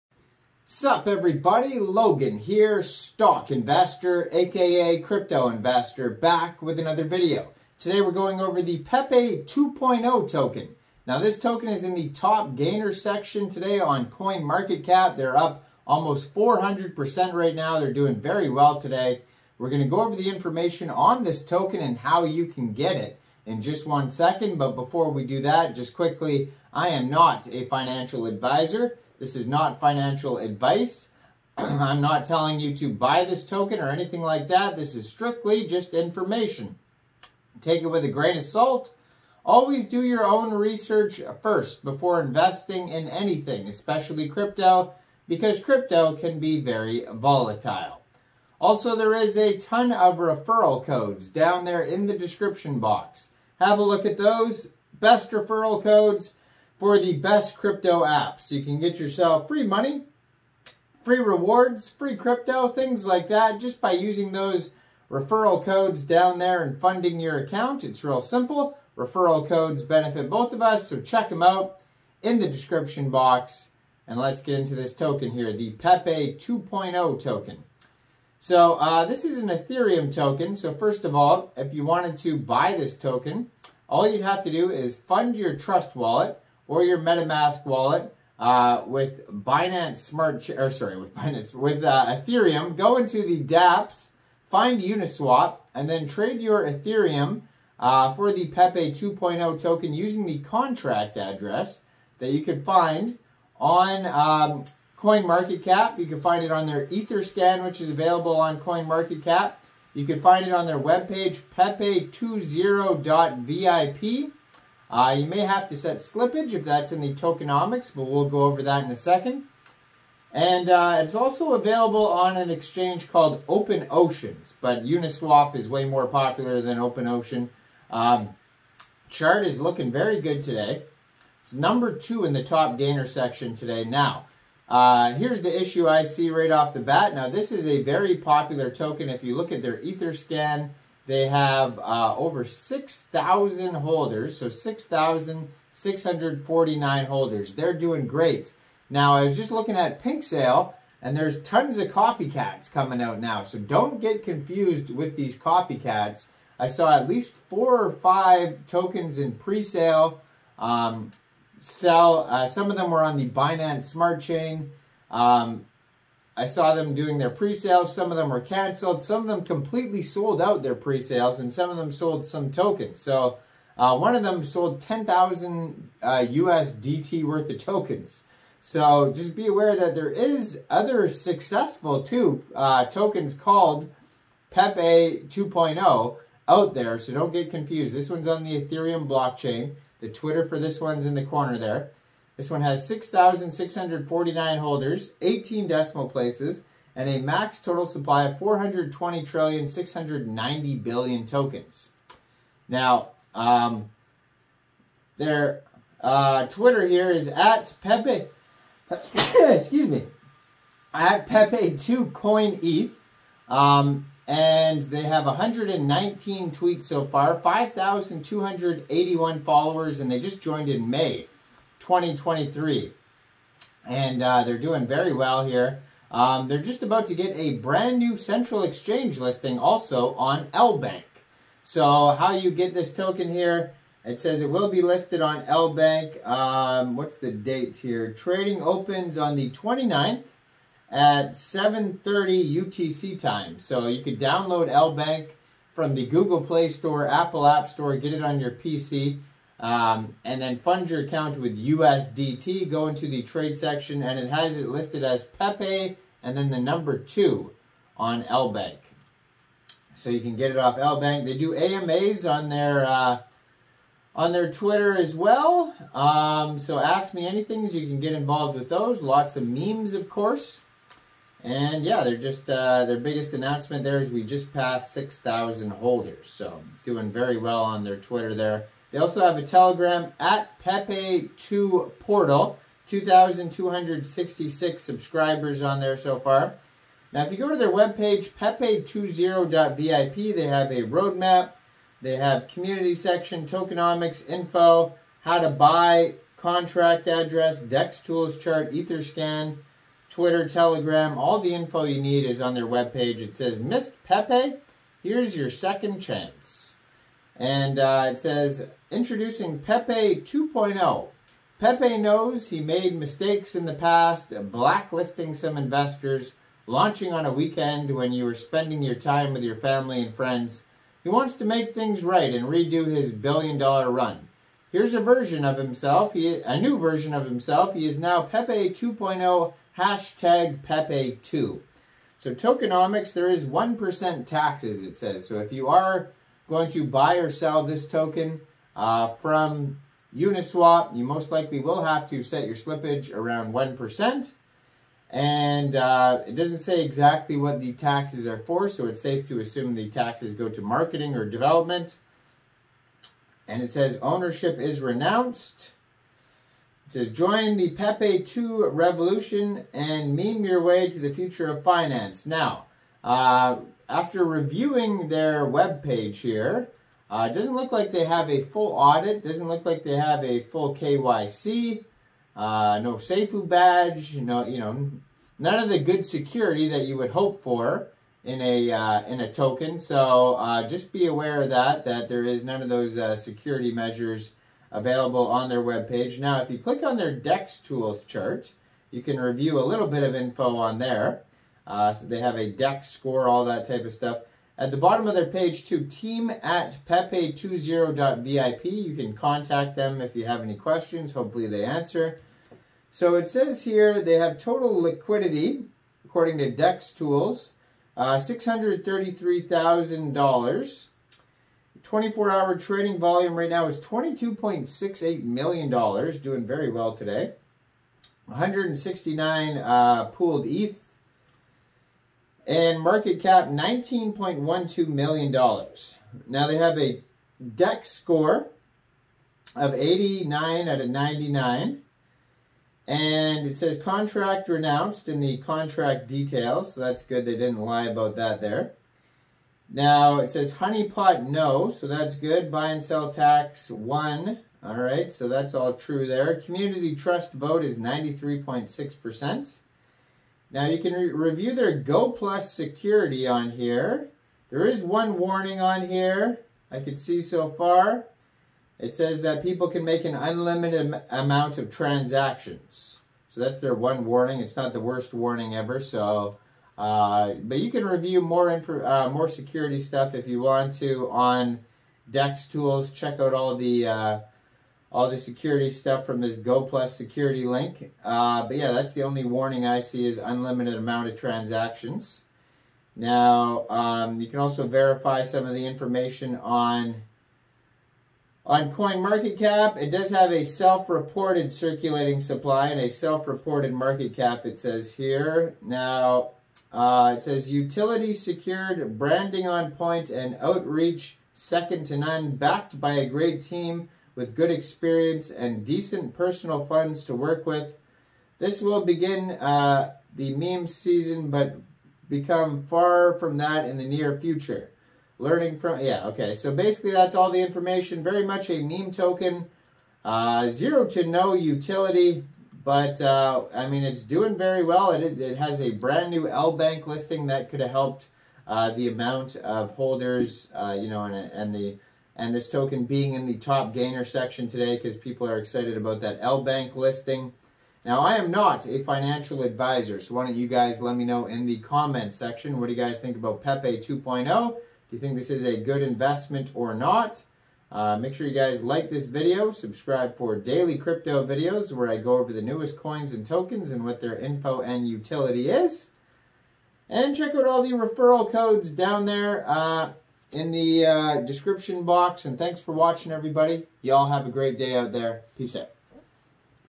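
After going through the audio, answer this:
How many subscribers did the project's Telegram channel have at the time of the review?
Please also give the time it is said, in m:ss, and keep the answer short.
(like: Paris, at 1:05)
2,266, at 4:42.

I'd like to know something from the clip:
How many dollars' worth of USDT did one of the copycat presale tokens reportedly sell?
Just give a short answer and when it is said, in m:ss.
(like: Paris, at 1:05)
10,000, at 2:54.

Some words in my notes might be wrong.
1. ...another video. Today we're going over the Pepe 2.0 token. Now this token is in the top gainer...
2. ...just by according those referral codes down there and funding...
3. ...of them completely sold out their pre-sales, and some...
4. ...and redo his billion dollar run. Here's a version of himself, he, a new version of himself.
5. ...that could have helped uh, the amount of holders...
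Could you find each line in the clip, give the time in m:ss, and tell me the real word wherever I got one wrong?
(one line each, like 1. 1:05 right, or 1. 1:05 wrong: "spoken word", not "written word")
1. 0:06 right
2. 1:03 wrong: "using", not "according"
3. 2:49 right
4. 5:22 right
5. 8:47 right.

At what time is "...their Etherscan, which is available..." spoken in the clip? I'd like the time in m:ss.
1:46.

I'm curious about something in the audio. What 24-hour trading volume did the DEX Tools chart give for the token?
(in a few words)
$22.68 million.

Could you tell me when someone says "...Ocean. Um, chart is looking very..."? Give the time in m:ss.
2:07.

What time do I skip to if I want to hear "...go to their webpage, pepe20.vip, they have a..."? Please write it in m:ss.
4:47.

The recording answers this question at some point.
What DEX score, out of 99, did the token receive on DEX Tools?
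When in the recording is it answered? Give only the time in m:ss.
7:09.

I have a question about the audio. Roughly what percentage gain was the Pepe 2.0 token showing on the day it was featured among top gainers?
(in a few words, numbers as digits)
400%.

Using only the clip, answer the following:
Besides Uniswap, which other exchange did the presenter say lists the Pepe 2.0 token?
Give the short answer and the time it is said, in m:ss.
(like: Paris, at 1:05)
Open Oceans, at 2:03.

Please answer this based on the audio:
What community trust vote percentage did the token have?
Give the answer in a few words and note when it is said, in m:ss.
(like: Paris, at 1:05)
93.6%, at 7:27.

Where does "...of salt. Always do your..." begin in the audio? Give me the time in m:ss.
0:38.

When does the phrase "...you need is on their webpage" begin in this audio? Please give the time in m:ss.
5:01.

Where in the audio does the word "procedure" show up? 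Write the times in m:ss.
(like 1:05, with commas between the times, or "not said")
not said.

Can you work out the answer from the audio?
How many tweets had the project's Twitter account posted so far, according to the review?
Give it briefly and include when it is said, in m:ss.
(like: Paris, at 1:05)
119, at 3:35.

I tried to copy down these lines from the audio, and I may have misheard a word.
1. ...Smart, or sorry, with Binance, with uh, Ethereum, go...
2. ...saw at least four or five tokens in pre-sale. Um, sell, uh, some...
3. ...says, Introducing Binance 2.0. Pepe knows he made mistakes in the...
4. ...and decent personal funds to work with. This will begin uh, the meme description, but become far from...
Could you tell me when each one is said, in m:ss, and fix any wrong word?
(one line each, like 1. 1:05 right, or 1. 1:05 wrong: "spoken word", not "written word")
1. 1:29 right
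2. 2:36 right
3. 5:08 wrong: "Pepe", not "Binance"
4. 8:25 wrong: "season", not "description".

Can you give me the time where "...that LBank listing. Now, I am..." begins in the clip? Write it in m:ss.
8:56.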